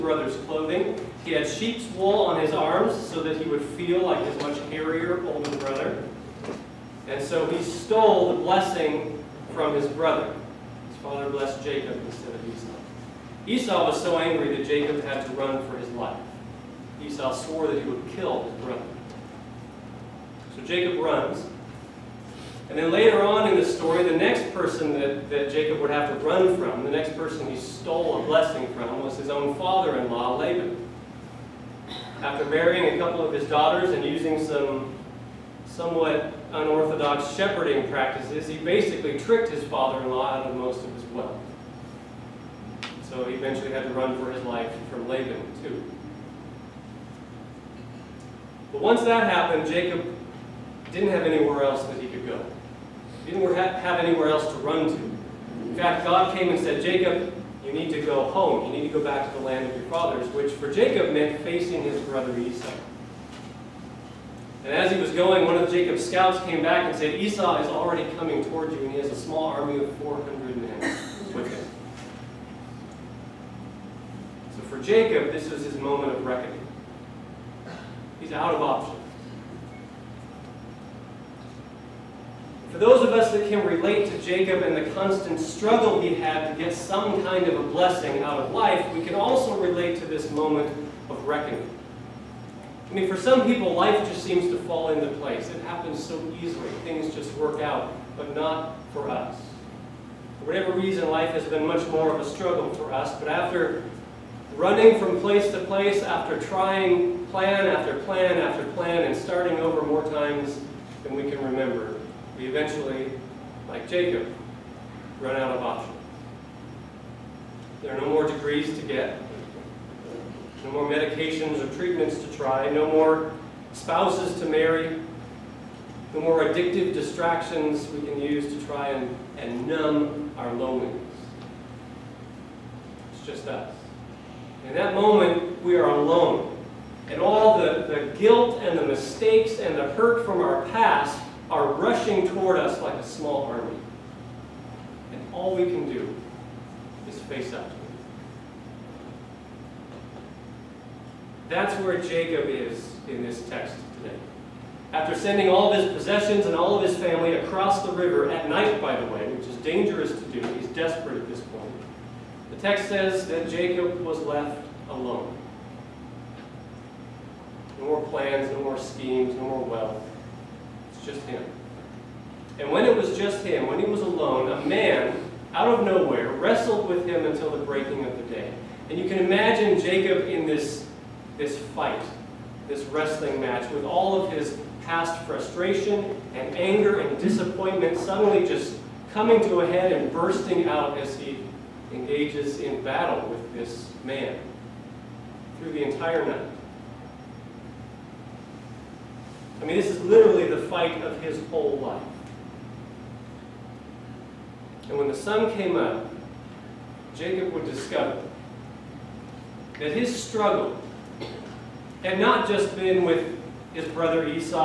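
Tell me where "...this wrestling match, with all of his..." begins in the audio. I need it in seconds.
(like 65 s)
182 s.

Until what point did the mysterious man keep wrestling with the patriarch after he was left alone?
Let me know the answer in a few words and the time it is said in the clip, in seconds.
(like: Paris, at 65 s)
The breaking of the day, at 177 s.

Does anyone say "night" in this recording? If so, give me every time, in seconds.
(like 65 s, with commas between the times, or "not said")
158 s, 196 s.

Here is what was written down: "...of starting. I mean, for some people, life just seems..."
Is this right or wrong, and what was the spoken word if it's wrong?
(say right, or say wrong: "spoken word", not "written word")
wrong: "reckoning", not "starting".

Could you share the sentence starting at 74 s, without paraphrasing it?
So for Jacob, this was his moment of reckoning.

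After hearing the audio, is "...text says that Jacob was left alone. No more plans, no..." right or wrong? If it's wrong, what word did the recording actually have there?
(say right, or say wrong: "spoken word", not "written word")
right.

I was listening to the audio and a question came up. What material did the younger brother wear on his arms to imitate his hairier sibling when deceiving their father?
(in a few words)
Sheep's wool.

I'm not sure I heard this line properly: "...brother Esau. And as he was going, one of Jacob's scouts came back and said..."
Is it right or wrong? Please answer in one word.
right.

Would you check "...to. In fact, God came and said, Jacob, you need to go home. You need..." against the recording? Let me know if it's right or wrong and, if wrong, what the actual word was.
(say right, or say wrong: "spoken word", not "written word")
right.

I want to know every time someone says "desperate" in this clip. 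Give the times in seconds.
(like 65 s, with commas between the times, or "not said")
160 s.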